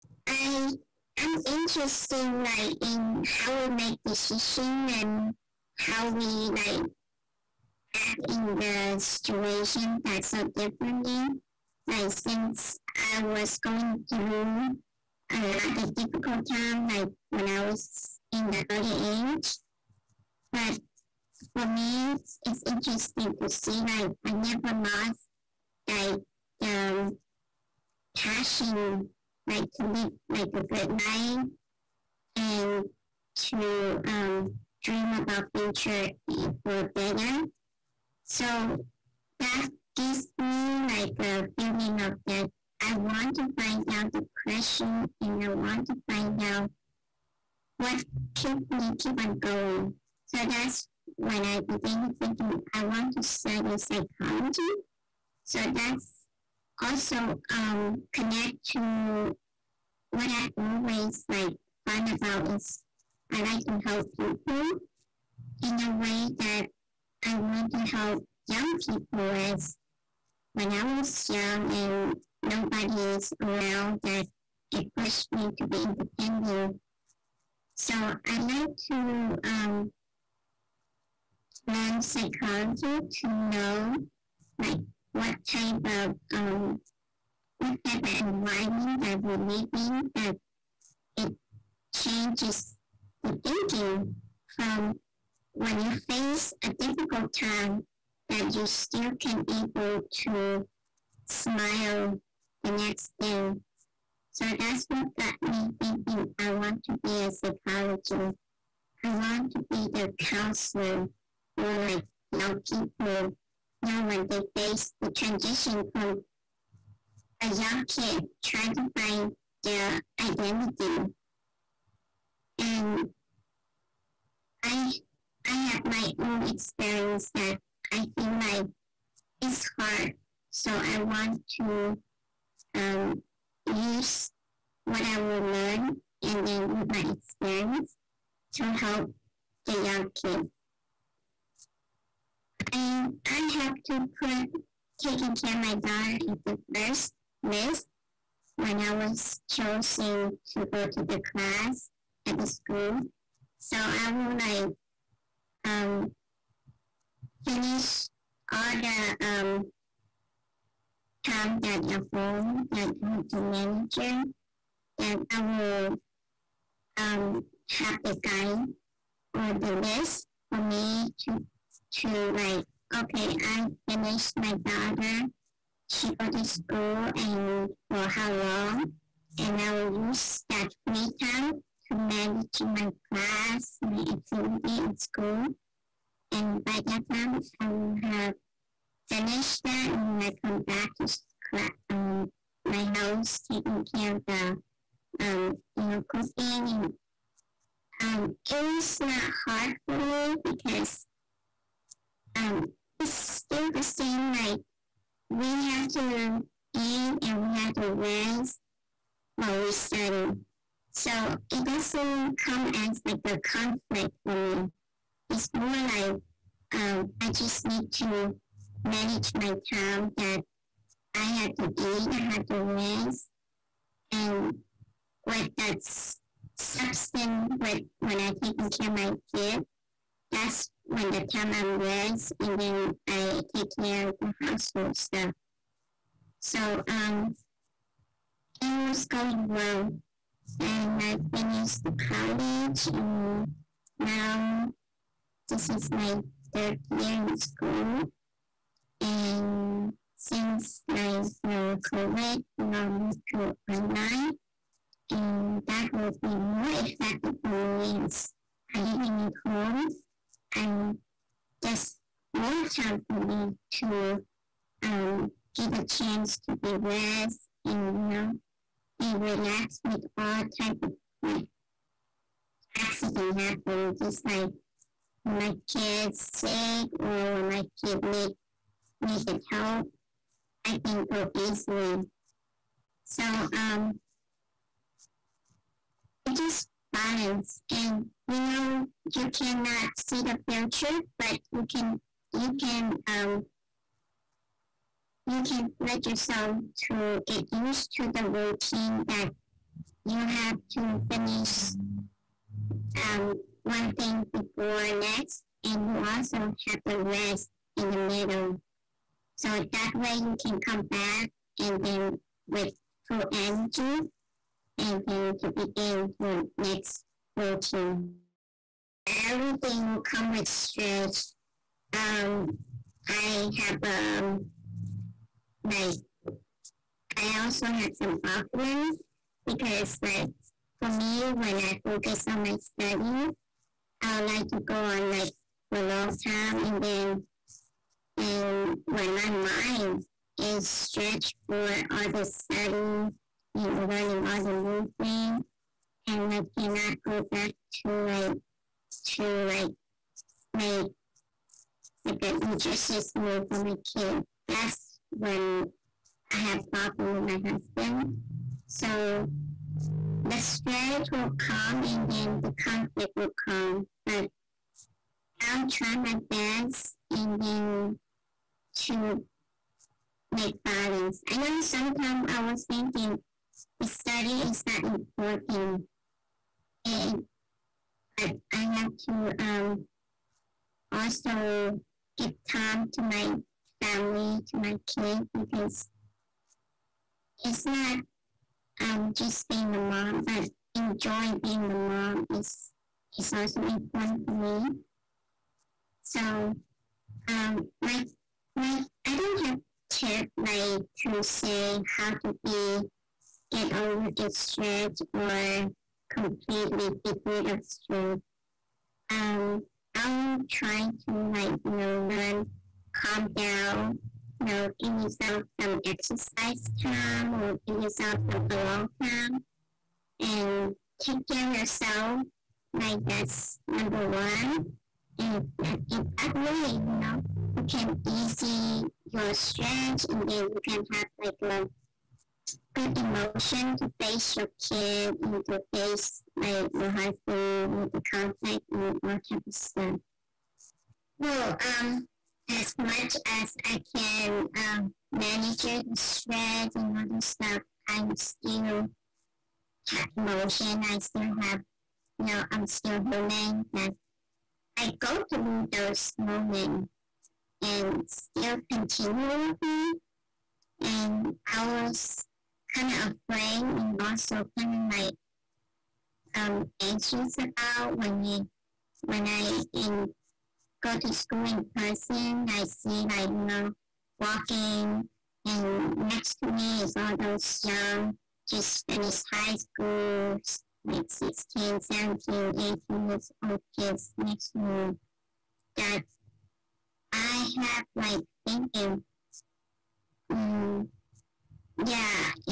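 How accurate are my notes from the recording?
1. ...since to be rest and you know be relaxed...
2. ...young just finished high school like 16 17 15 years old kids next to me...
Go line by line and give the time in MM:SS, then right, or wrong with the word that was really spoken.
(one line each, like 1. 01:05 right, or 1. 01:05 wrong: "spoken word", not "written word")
1. 04:25 wrong: "chance", not "since"
2. 07:57 wrong: "18", not "15".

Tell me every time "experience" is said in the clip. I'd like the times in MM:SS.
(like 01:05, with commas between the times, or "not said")
02:06, 02:17.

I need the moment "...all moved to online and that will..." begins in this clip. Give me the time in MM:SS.
04:12.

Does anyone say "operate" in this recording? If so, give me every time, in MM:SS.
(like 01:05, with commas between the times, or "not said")
not said.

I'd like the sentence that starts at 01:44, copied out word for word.
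So that's what got me thinking I want to be a psychologist.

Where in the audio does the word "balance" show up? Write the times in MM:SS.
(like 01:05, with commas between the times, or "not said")
04:46, 06:10.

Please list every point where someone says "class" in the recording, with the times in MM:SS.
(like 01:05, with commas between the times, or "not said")
02:31, 03:03.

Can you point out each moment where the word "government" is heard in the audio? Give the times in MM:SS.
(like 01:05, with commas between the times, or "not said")
not said.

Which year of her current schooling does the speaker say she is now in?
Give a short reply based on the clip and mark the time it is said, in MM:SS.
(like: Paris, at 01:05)
third year, at 04:06.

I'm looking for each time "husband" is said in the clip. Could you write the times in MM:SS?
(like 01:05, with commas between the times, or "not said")
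05:57, 07:16.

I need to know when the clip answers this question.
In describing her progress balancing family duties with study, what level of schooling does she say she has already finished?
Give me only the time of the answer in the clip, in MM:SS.
04:02.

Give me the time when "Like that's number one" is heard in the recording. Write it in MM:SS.
07:02.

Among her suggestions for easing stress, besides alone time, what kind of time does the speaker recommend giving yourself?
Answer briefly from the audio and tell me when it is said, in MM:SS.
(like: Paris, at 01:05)
exercise time, at 06:55.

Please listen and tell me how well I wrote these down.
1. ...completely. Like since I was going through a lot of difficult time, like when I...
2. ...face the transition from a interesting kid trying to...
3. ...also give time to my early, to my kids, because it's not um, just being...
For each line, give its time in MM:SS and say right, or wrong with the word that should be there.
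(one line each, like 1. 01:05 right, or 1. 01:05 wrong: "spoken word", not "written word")
1. 00:10 wrong: "differently", not "completely"
2. 01:54 wrong: "young", not "interesting"
3. 06:20 wrong: "family", not "early".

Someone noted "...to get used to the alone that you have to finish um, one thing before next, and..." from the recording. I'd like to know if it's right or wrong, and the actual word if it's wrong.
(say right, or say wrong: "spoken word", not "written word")
wrong: "routine", not "alone".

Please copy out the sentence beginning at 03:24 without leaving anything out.
Like we have to eat and we have to rest while we study.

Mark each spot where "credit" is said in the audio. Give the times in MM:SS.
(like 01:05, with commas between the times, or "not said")
not said.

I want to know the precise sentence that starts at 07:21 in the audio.
Well, um, as much as I can um, manage the stress and all the stuff, I'm still have emotion.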